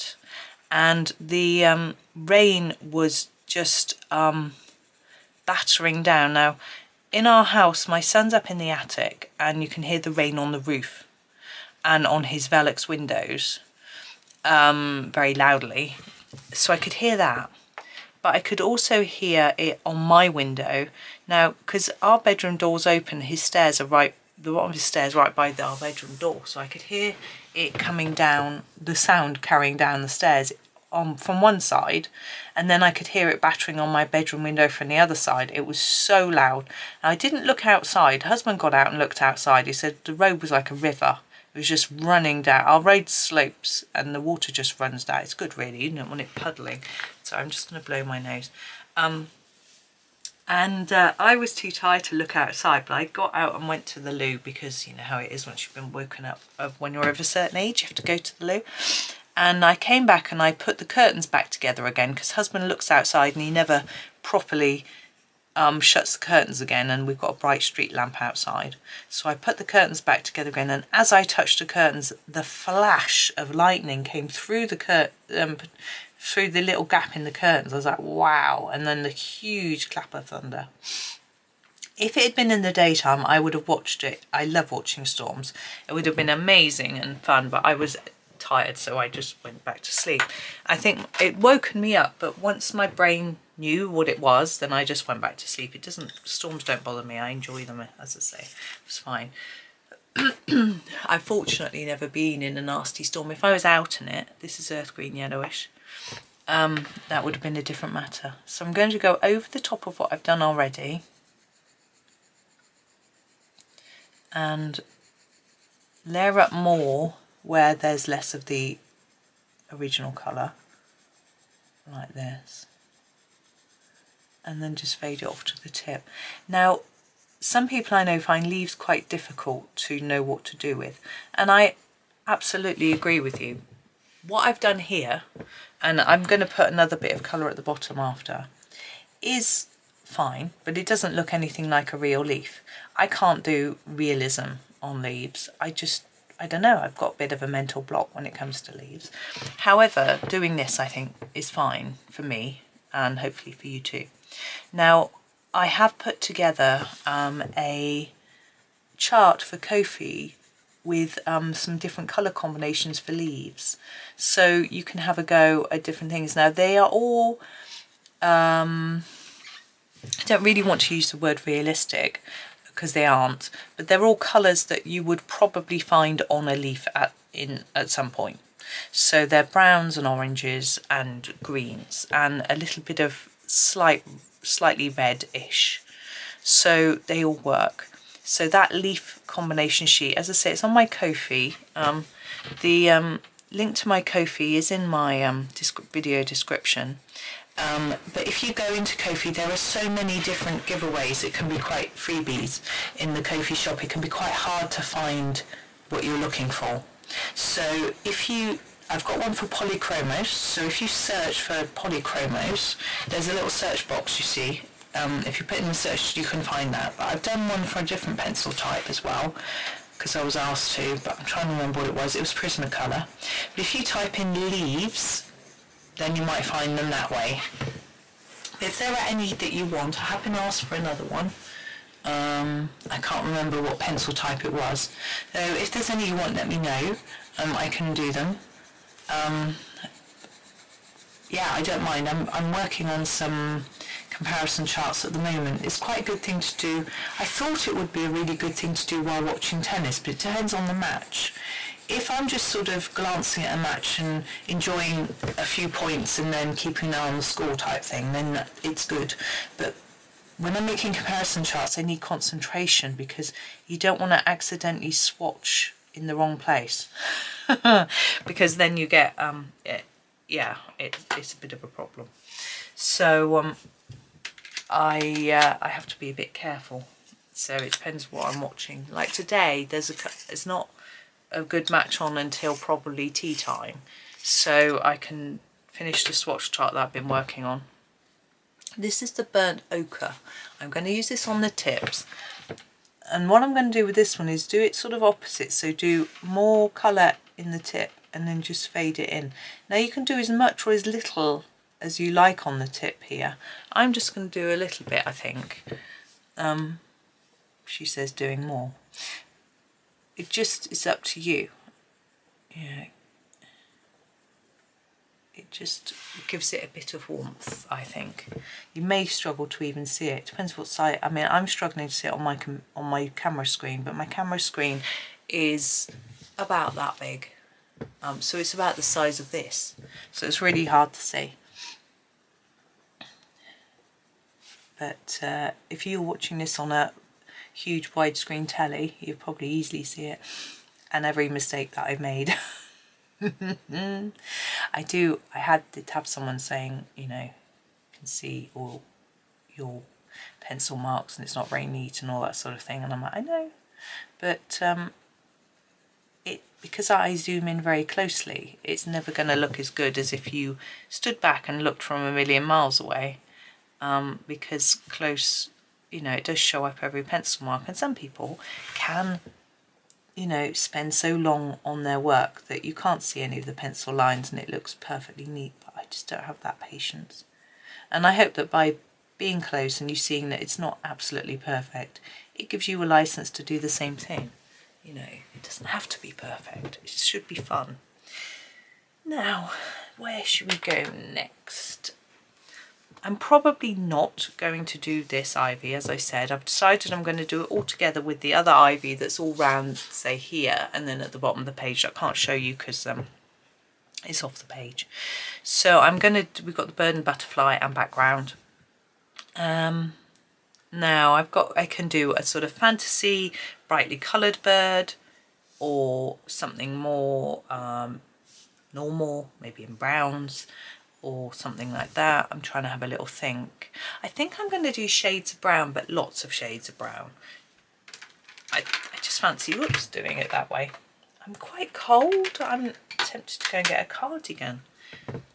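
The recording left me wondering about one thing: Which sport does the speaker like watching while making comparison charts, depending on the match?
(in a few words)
tennis.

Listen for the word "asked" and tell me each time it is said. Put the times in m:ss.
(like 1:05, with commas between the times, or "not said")
3:40, 3:50.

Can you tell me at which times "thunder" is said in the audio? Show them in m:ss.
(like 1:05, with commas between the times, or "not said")
1:20.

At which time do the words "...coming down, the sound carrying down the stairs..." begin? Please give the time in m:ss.
0:27.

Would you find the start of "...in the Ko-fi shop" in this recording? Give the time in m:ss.
3:22.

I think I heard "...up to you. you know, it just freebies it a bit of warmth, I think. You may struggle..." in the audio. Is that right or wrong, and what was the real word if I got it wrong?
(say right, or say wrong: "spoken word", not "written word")
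wrong: "gives", not "freebies".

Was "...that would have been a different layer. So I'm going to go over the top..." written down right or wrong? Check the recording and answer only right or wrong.
wrong.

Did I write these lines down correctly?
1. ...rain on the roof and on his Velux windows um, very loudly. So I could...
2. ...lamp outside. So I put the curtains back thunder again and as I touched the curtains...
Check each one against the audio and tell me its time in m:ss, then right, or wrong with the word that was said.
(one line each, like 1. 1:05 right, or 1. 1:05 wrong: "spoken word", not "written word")
1. 0:10 right
2. 1:07 wrong: "together", not "thunder".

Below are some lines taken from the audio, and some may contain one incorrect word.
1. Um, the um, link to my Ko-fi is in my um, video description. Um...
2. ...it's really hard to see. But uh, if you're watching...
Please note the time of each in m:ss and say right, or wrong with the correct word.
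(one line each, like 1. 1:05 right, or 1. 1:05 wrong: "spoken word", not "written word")
1. 3:11 right
2. 5:30 right.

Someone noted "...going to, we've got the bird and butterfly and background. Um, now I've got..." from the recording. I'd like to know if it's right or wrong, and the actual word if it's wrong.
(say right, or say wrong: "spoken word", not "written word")
right.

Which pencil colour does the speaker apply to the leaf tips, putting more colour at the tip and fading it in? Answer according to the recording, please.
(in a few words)
burnt ochre.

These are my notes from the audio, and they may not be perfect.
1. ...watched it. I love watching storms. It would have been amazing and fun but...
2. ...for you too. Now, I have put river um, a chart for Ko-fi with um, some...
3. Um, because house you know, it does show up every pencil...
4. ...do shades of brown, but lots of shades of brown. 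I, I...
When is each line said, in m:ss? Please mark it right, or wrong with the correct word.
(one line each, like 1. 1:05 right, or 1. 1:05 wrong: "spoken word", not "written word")
1. 1:23 right
2. 2:33 wrong: "together", not "river"
3. 6:03 wrong: "close", not "house"
4. 7:04 right.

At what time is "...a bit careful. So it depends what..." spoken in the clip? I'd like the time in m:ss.
4:36.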